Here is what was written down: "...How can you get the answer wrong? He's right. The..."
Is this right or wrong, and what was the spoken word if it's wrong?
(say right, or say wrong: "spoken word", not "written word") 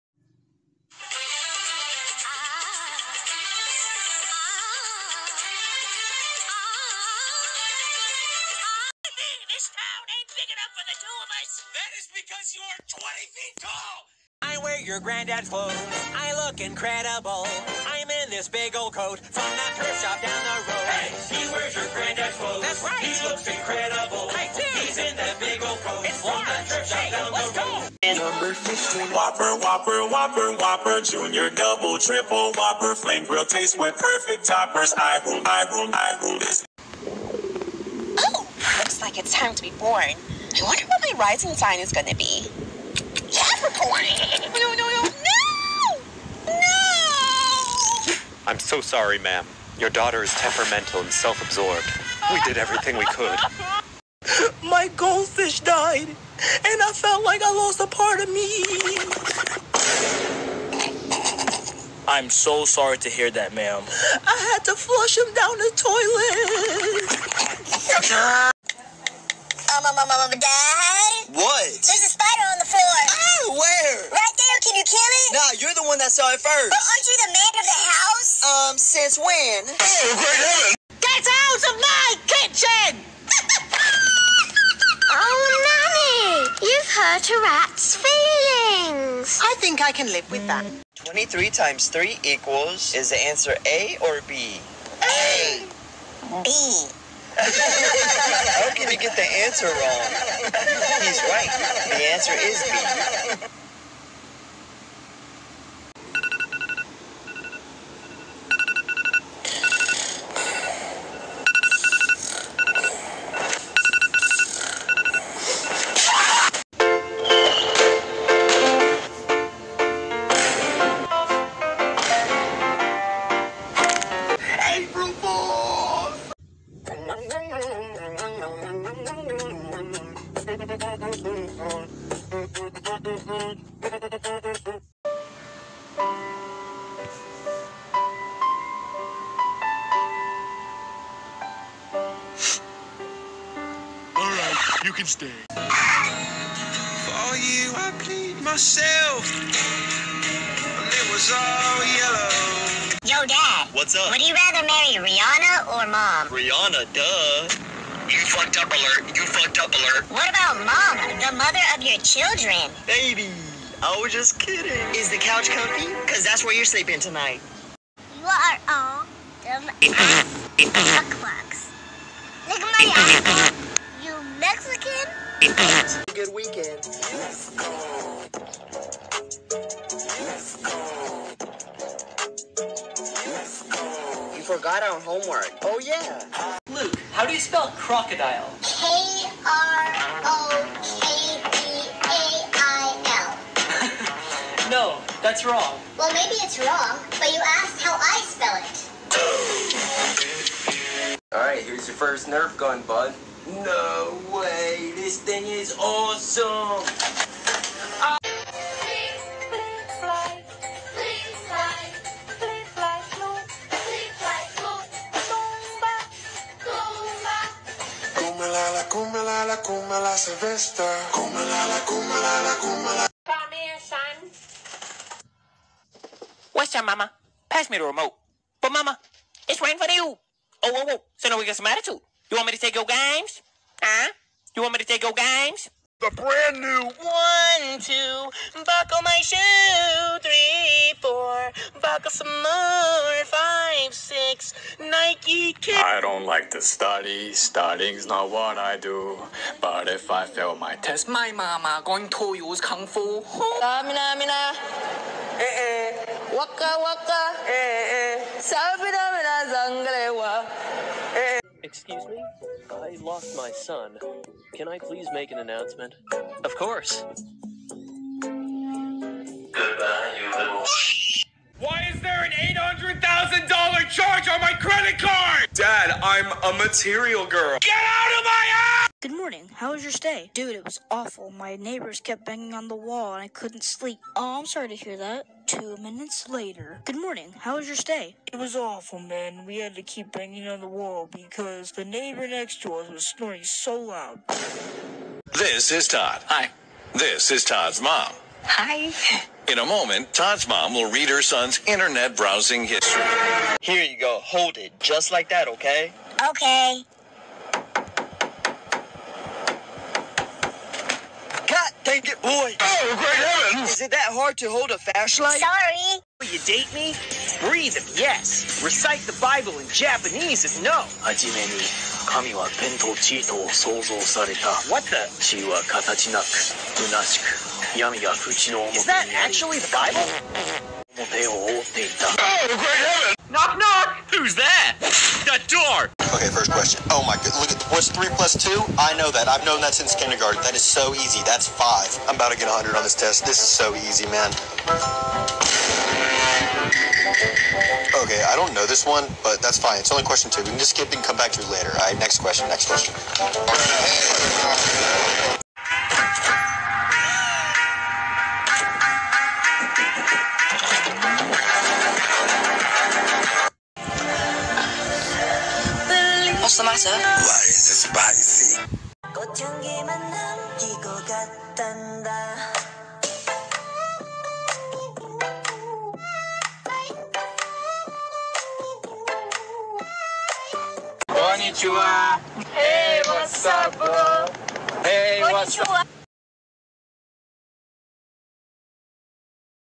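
right.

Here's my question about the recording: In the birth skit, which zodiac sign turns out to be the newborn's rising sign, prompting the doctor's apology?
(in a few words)
Capricorn.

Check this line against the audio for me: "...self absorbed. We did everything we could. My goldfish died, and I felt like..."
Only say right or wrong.
right.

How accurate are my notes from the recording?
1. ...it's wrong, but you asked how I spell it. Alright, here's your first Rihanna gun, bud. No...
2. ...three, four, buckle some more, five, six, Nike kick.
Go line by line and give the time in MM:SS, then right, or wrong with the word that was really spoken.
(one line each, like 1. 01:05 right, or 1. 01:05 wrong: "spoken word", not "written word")
1. 03:16 wrong: "Nerf", not "Rihanna"
2. 04:00 right.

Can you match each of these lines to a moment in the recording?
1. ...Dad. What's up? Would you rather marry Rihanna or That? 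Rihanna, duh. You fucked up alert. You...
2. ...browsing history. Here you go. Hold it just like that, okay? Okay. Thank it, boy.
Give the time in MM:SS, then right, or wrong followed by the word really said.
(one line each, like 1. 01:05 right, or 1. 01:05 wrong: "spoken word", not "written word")
1. 02:33 wrong: "Mom", not "That"
2. 05:02 right.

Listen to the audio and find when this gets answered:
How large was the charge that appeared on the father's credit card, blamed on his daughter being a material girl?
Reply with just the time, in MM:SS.
04:32.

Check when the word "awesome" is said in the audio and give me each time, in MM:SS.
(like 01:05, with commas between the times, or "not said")
03:25.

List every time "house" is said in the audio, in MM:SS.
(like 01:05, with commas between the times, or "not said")
01:17, 04:38.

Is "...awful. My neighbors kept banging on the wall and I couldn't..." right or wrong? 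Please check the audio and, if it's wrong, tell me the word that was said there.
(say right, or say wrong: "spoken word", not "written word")
right.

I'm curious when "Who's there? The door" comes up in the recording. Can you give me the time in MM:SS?
05:34.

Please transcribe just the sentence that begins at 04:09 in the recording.
But if I fail my test, my mama going to use kung fu.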